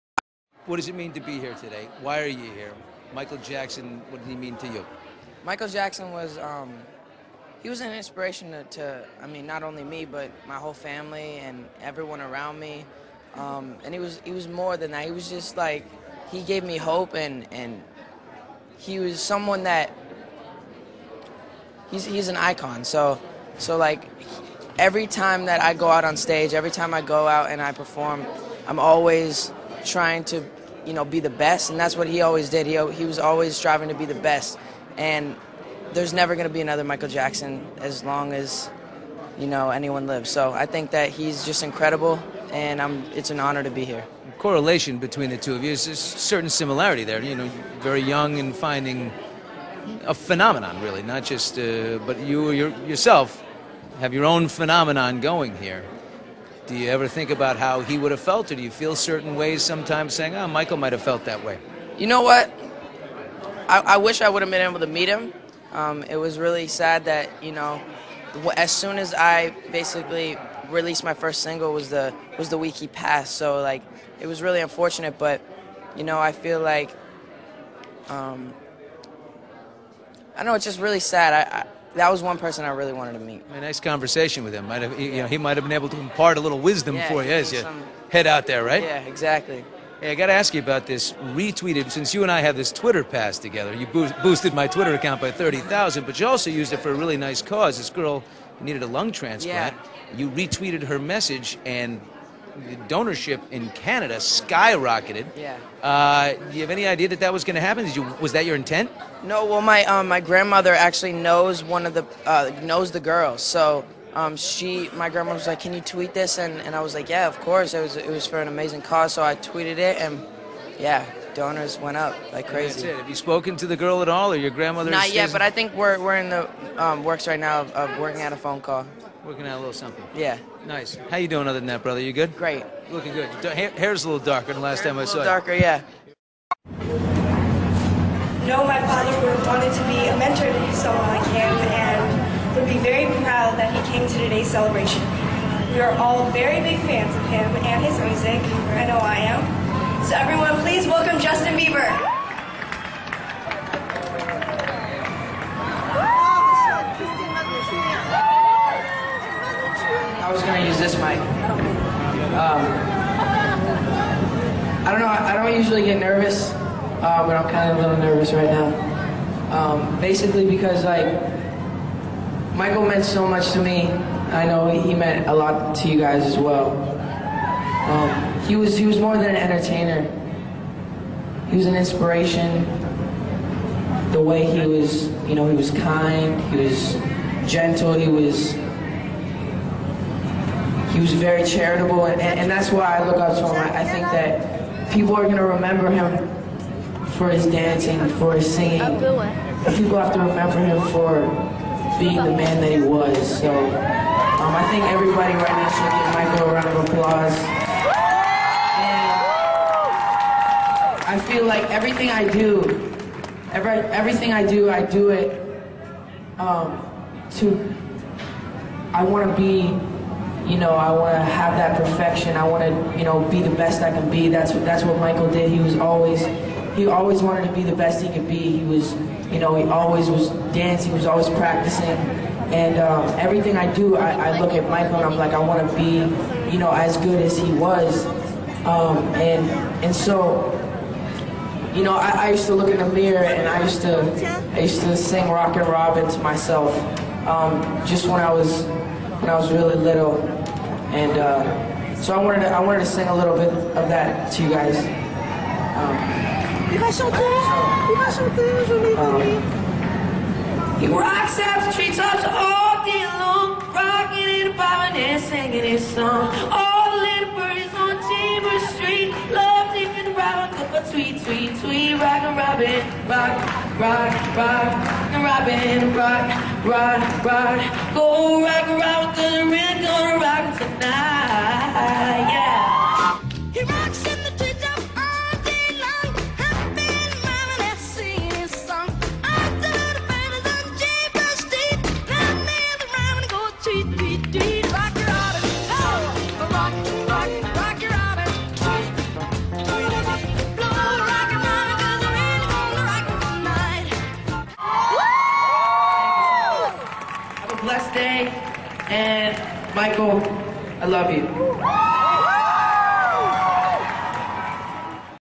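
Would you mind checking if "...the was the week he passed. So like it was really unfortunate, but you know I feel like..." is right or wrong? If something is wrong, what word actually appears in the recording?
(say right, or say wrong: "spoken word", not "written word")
right.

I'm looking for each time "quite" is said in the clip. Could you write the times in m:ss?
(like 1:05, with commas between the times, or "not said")
not said.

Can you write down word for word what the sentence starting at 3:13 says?
I, I think that people are gonna remember him for his dancing, for his singing.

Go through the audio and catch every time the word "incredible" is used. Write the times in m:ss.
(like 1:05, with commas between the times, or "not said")
0:41.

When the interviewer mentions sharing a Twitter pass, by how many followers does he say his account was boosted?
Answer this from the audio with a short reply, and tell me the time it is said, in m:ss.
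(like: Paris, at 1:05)
30,000, at 1:35.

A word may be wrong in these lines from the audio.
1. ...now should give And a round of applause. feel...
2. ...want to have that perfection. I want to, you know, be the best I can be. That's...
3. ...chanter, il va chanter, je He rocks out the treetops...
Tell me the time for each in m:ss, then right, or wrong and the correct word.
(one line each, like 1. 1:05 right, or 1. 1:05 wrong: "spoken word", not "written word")
1. 3:25 wrong: "Michael", not "And"
2. 3:40 right
3. 4:16 right.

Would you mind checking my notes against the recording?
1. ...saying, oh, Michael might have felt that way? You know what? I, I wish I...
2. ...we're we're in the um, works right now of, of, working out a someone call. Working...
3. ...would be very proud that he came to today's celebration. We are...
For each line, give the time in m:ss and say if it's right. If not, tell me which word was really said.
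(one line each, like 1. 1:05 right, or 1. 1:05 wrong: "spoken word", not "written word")
1. 1:00 right
2. 2:05 wrong: "phone", not "someone"
3. 2:22 right.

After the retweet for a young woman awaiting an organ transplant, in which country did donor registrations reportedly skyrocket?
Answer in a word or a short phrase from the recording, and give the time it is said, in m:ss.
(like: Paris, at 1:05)
Canada, at 1:43.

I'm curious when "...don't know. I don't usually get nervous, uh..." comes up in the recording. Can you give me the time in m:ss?
2:44.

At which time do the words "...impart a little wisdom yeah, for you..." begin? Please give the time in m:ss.
1:25.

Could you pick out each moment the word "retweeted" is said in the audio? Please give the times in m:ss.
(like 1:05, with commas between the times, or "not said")
1:31, 1:40.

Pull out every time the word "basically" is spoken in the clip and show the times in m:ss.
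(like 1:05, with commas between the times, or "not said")
1:09, 2:50.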